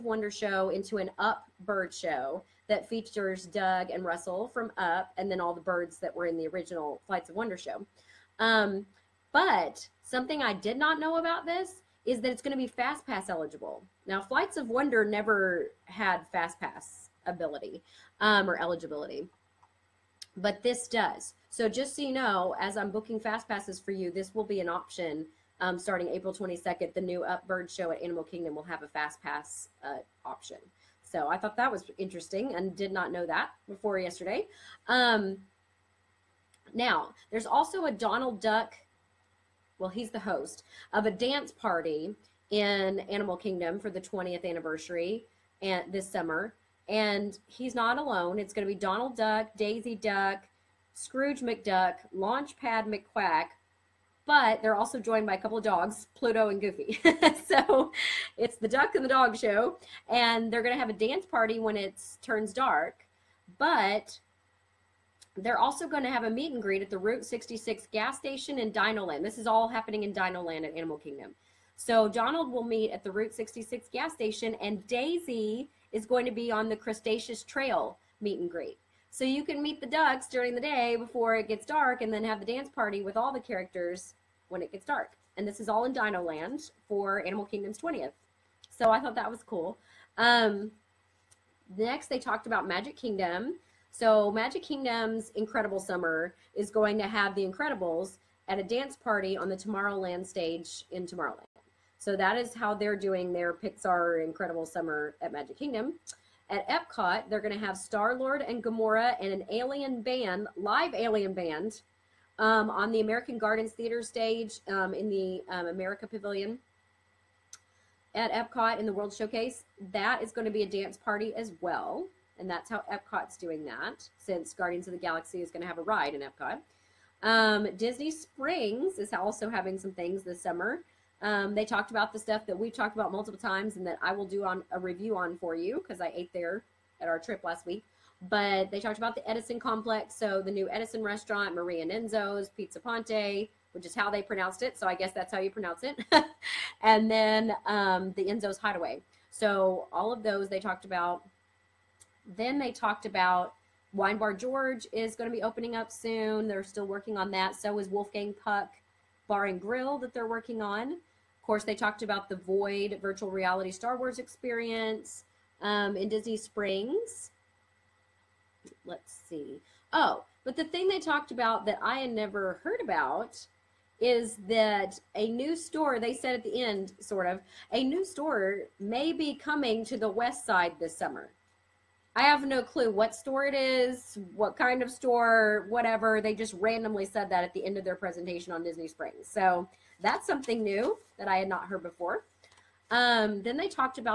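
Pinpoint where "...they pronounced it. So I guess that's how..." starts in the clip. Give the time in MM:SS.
02:24.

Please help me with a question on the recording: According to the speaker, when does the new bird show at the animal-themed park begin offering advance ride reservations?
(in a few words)
April 22nd.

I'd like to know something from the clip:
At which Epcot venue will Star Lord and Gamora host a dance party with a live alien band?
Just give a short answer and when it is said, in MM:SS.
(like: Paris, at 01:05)
American Gardens Theater, at 01:52.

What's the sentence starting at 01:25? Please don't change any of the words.
And this is all in Dinoland for Animal Kingdom's 20th.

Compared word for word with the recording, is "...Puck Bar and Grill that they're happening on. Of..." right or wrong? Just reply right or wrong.
wrong.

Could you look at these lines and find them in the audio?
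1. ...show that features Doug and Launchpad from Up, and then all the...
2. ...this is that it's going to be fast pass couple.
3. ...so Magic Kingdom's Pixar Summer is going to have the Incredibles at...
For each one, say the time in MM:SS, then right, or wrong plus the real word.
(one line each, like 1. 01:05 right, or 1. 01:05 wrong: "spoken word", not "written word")
1. 00:01 wrong: "Russell", not "Launchpad"
2. 00:11 wrong: "eligible", not "couple"
3. 01:33 wrong: "Incredible", not "Pixar".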